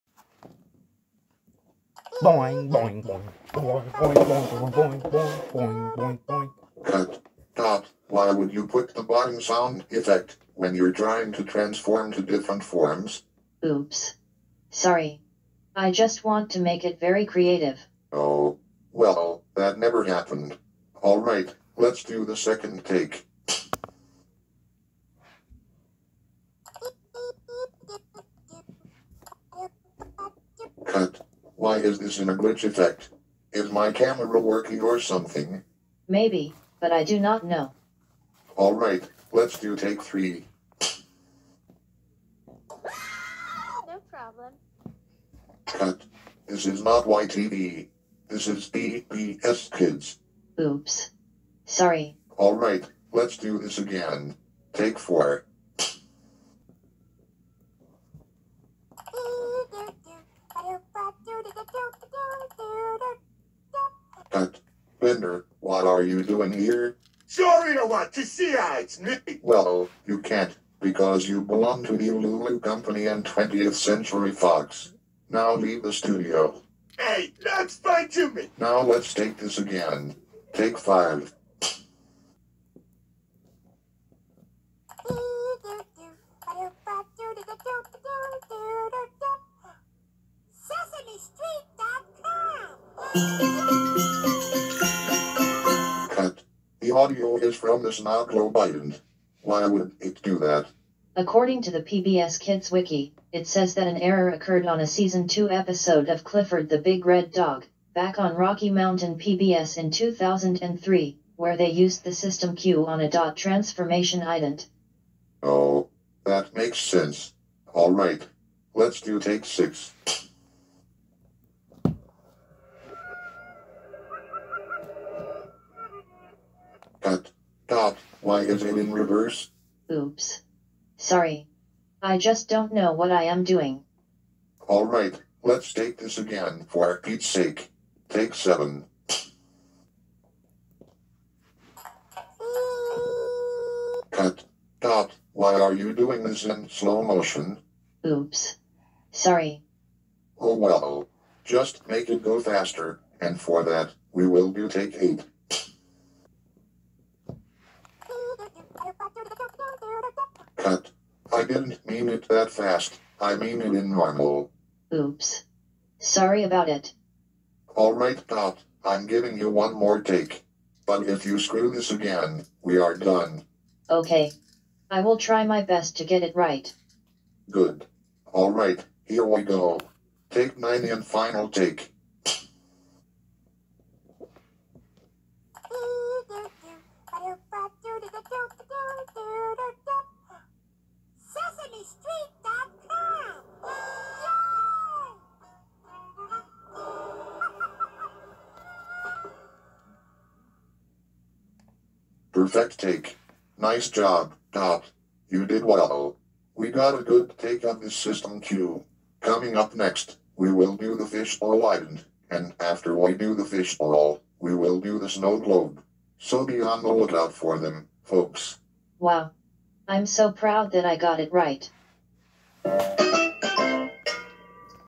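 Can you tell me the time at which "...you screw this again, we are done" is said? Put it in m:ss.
2:51.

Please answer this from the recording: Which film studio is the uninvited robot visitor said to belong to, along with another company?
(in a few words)
20th Century Fox.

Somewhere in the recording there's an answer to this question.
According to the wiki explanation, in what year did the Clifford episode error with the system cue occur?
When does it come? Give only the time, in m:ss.
1:49.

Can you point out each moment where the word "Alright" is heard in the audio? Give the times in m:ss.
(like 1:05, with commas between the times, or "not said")
0:38, 0:52, 2:47, 2:58.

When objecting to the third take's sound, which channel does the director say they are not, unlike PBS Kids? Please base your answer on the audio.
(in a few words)
YTV.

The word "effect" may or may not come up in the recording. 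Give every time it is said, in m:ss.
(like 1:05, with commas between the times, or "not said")
0:09, 0:32.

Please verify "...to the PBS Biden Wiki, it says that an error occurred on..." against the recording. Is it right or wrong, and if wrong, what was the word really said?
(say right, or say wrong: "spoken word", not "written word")
wrong: "Kids", not "Biden".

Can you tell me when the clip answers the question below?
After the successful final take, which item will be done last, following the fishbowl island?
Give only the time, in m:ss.
3:35.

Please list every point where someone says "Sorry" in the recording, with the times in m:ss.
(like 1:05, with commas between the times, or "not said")
0:14, 0:51, 2:10, 2:29, 2:45.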